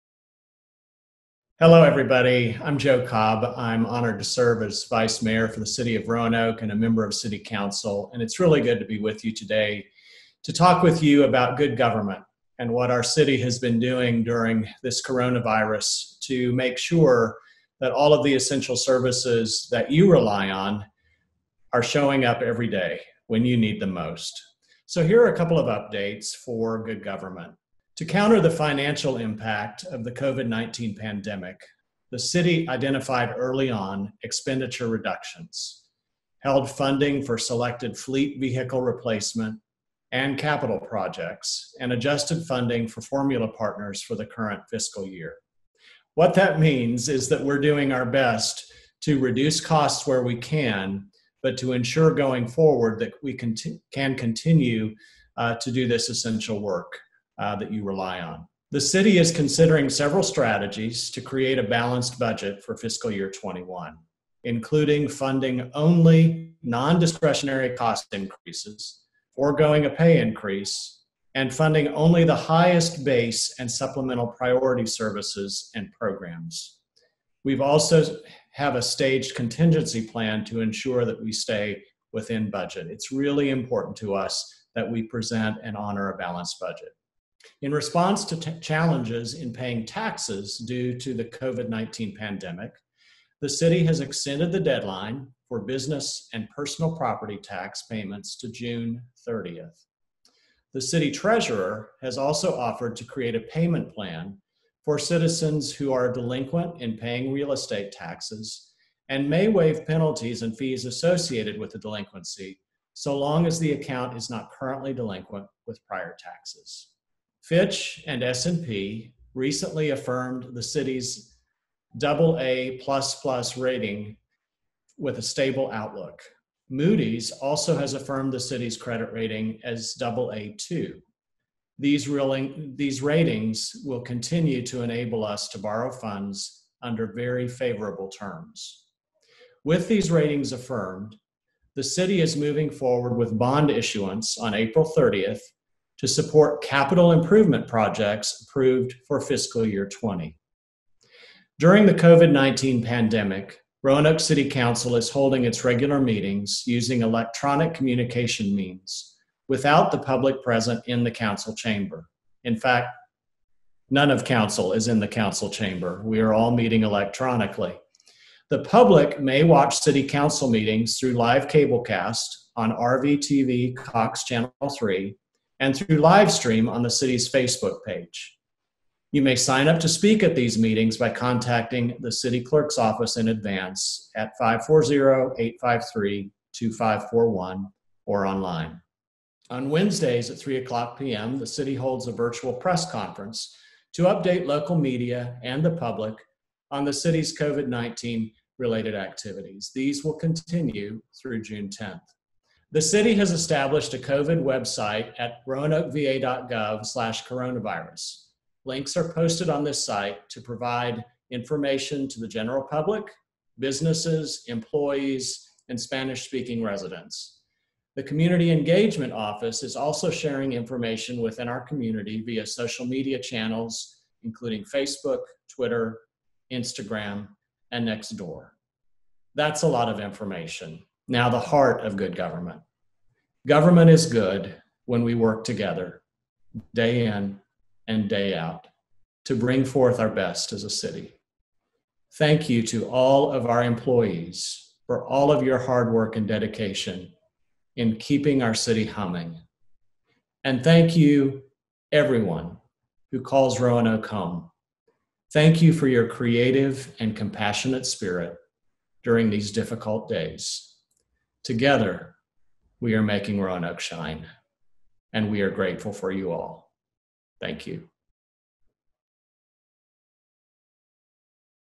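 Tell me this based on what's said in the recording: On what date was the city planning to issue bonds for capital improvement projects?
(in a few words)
April 30th.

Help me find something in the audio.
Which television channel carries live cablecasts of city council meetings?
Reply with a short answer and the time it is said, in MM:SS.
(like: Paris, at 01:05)
RVTV Cox Channel 3, at 02:52.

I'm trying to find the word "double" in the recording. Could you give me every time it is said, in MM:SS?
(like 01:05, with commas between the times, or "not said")
02:01, 02:09.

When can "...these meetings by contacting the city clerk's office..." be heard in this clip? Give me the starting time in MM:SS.
03:00.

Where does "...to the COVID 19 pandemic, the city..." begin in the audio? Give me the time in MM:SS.
01:30.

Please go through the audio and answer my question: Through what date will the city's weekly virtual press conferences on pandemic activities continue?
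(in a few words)
June 10th.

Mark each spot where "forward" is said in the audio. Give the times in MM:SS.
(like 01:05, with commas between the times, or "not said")
00:52, 02:22.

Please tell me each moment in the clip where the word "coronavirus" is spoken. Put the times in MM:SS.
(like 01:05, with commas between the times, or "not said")
00:15, 03:27.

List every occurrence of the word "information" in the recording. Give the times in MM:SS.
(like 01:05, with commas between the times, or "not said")
03:31, 03:40, 03:49.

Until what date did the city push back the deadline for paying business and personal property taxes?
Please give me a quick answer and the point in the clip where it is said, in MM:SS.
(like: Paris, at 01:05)
June 30th, at 01:38.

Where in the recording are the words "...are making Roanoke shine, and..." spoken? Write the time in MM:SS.
04:22.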